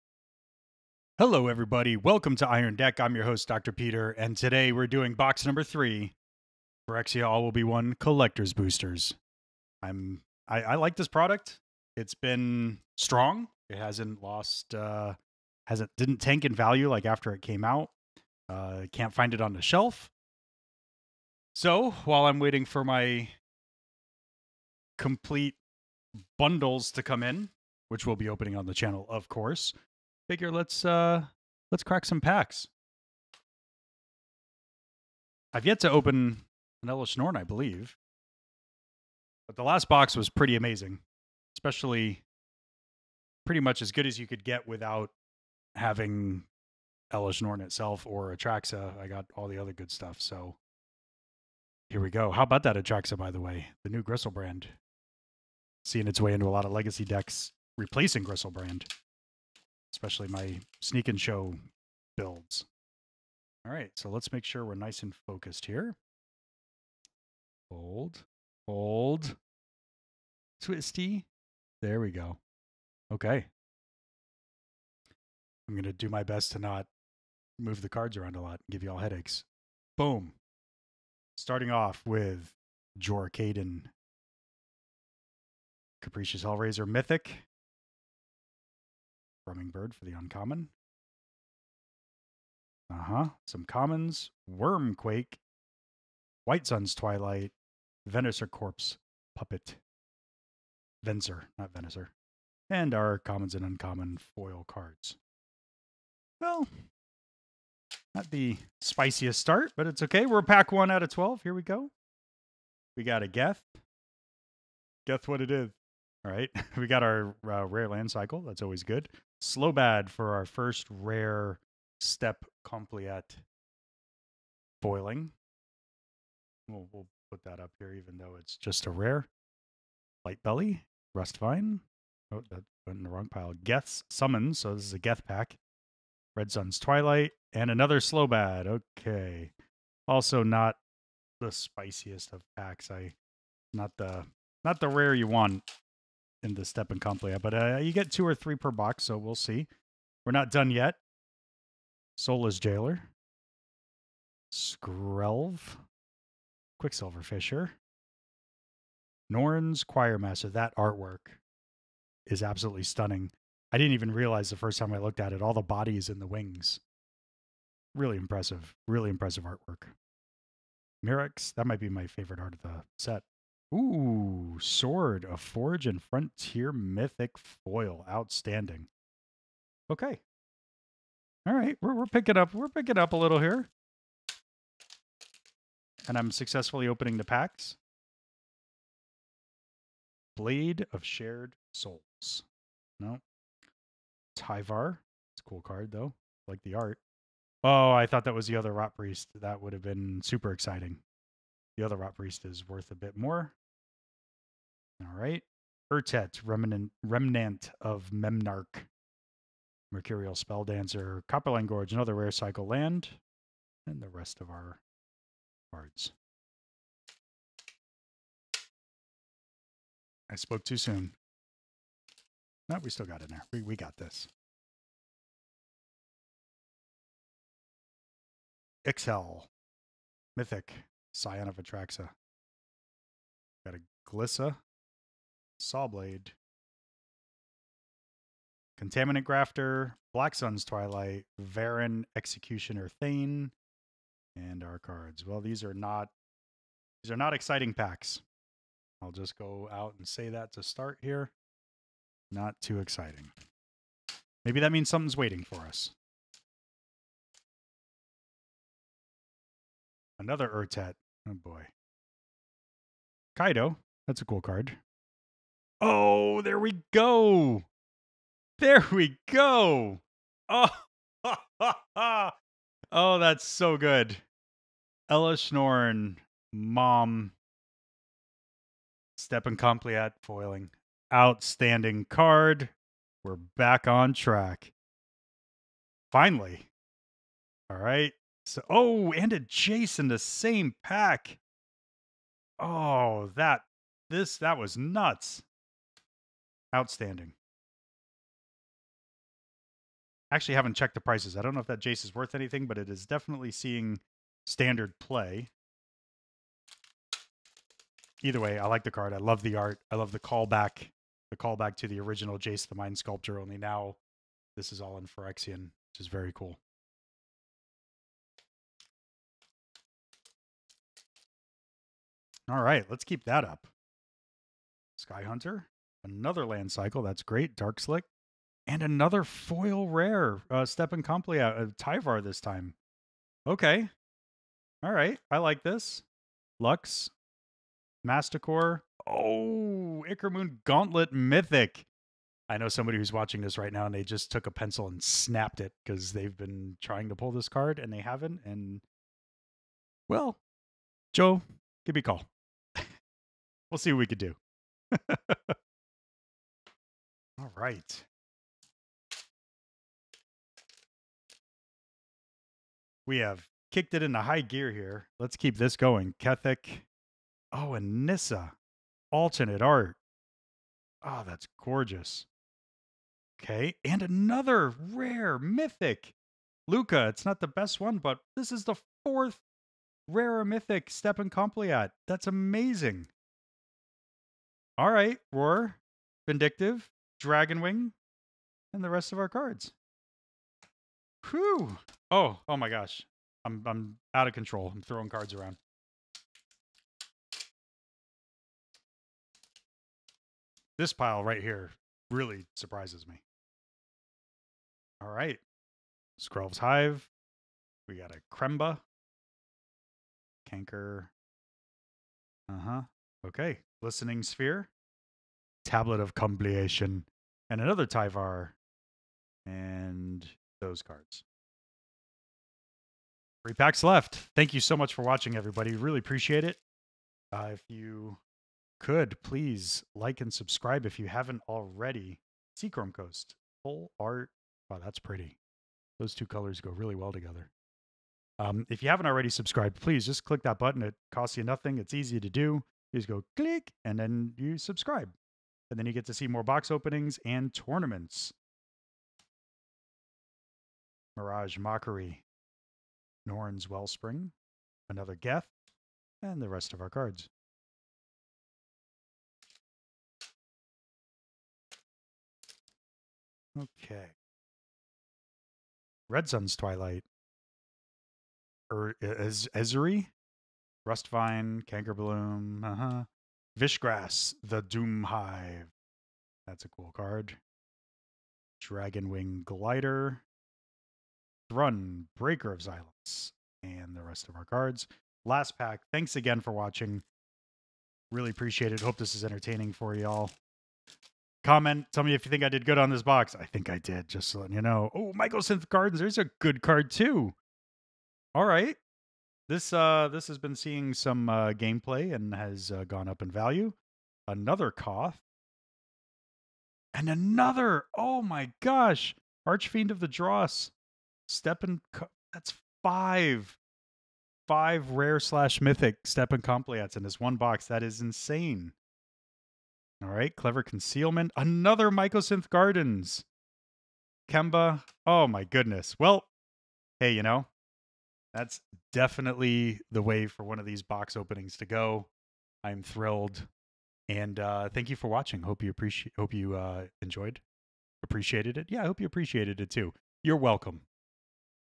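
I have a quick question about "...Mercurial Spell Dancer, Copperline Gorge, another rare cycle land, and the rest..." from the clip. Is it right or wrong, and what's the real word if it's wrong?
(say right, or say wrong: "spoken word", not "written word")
right.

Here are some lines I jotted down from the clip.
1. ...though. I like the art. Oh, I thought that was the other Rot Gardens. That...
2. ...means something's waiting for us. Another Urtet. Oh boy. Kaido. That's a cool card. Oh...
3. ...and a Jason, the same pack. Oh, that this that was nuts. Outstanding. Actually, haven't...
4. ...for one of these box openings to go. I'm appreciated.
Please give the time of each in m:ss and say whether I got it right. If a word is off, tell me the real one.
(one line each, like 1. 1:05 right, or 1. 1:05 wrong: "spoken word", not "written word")
1. 3:15 wrong: "Priest", not "Gardens"
2. 4:14 right
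3. 4:49 right
4. 8:50 wrong: "thrilled", not "appreciated".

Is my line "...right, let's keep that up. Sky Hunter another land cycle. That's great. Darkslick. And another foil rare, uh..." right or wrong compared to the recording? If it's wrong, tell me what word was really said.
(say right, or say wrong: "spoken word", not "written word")
right.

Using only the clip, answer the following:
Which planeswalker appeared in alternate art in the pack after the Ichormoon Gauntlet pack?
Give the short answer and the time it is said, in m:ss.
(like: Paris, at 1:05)
Nissa, at 6:08.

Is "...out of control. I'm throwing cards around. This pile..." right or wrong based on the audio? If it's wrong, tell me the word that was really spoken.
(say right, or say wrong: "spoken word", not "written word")
right.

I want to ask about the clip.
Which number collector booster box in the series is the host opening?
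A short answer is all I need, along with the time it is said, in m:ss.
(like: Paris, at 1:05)
3, at 0:05.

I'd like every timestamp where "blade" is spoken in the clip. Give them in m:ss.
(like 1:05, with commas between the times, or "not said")
3:10, 3:55.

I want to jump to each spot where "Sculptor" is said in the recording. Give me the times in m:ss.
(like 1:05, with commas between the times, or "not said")
5:12.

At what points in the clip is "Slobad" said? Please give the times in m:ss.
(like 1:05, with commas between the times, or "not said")
1:59, 2:17.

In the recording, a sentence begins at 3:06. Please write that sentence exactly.
And I'm successfully opening the packs.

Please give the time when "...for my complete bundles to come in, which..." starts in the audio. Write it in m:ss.
0:22.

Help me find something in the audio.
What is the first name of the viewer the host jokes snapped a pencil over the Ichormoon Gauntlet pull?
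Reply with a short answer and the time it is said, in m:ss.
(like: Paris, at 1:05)
Joe, at 5:51.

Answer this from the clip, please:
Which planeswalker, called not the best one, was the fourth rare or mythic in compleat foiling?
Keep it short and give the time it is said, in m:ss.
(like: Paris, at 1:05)
Lukka, at 6:16.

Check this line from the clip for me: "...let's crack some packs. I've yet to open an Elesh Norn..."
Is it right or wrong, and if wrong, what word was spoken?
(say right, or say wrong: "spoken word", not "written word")
right.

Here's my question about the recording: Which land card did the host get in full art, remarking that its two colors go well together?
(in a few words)
Seachrome Coast.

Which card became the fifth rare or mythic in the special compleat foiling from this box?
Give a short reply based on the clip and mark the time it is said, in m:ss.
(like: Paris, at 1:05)
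Archfiend of the Dross, at 8:29.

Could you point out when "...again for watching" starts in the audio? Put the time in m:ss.
8:06.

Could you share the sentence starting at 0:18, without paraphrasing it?
Uh can't find it on the shelf.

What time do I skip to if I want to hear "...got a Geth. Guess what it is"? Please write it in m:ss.
1:53.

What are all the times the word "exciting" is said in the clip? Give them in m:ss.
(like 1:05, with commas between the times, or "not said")
3:20, 4:07, 4:12.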